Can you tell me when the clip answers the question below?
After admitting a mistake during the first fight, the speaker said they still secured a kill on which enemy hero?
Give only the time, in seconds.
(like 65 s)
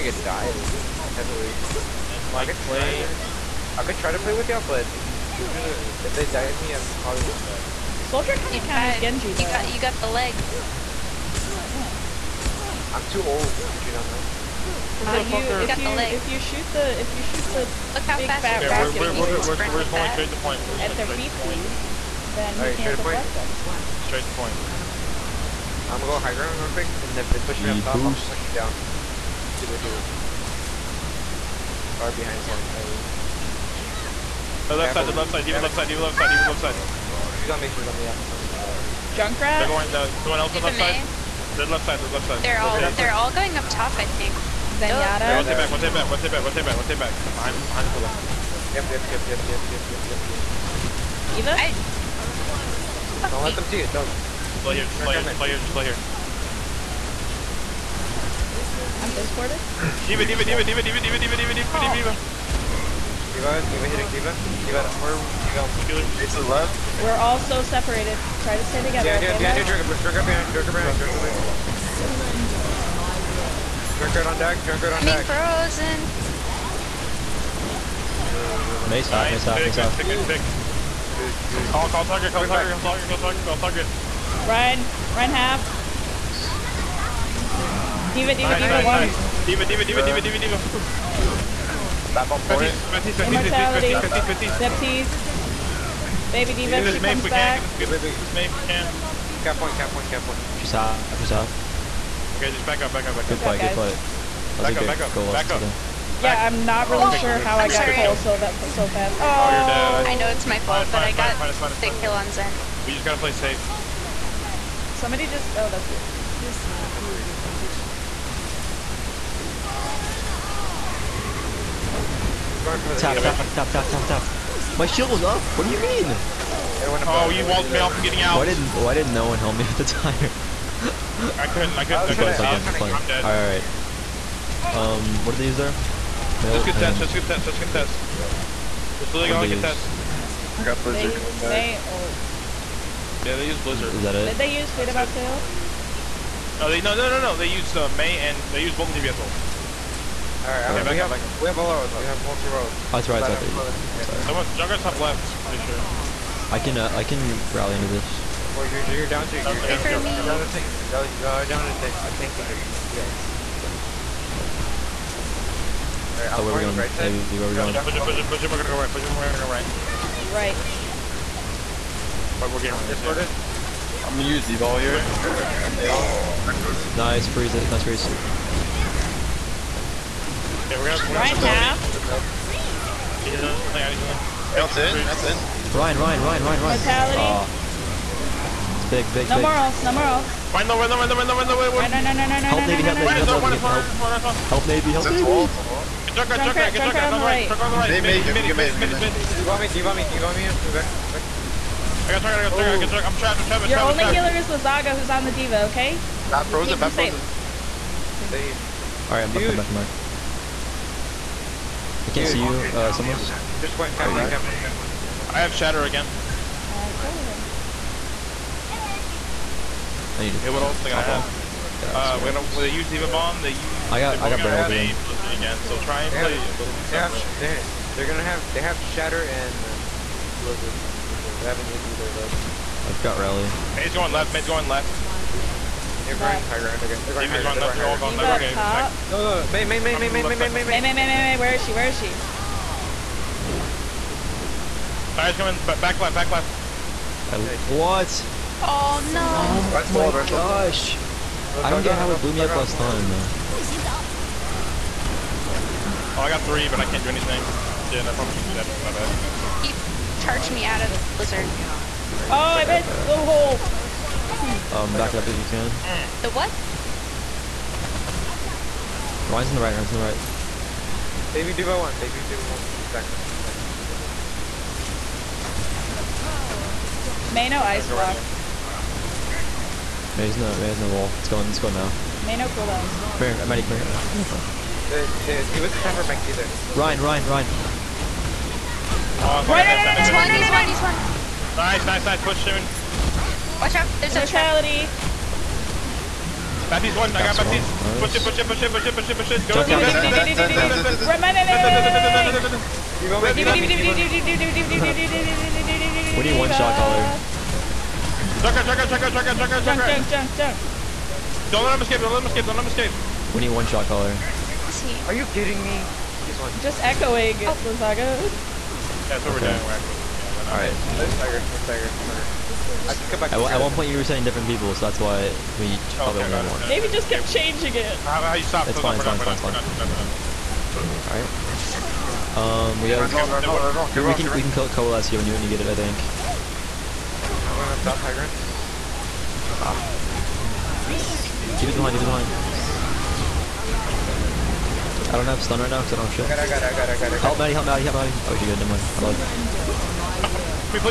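112 s.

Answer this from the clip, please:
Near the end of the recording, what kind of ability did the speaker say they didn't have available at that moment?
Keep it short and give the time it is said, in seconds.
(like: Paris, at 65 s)
Stun, at 345 s.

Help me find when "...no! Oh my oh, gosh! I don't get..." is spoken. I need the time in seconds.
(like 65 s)
249 s.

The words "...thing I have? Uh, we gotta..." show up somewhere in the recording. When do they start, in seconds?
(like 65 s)
220 s.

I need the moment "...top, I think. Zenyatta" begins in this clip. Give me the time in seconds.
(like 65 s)
43 s.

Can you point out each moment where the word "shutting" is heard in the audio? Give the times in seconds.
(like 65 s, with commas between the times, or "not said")
not said.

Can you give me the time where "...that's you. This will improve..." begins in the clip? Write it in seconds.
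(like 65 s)
115 s.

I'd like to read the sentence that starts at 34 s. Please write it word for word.
Oh, left side, left side, even left side, even left side, even left side.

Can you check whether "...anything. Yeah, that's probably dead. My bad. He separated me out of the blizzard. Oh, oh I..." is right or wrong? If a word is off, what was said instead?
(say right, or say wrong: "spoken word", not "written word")
wrong: "charged", not "separated".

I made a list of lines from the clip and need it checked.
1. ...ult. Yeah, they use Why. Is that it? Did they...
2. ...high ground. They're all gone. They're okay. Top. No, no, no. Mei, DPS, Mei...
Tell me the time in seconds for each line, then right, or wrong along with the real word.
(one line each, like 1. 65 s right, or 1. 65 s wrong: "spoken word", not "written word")
1. 141 s wrong: "Blizzard", not "Why"
2. 237 s wrong: "Mei", not "DPS".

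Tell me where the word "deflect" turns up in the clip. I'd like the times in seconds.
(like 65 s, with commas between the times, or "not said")
22 s.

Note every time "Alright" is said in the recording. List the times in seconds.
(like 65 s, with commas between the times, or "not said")
150 s, 166 s, 320 s, 330 s.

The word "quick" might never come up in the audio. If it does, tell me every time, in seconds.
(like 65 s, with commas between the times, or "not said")
26 s.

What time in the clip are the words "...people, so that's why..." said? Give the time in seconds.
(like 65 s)
324 s.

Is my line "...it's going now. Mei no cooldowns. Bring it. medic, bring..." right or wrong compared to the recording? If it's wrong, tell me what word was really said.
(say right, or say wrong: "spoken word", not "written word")
right.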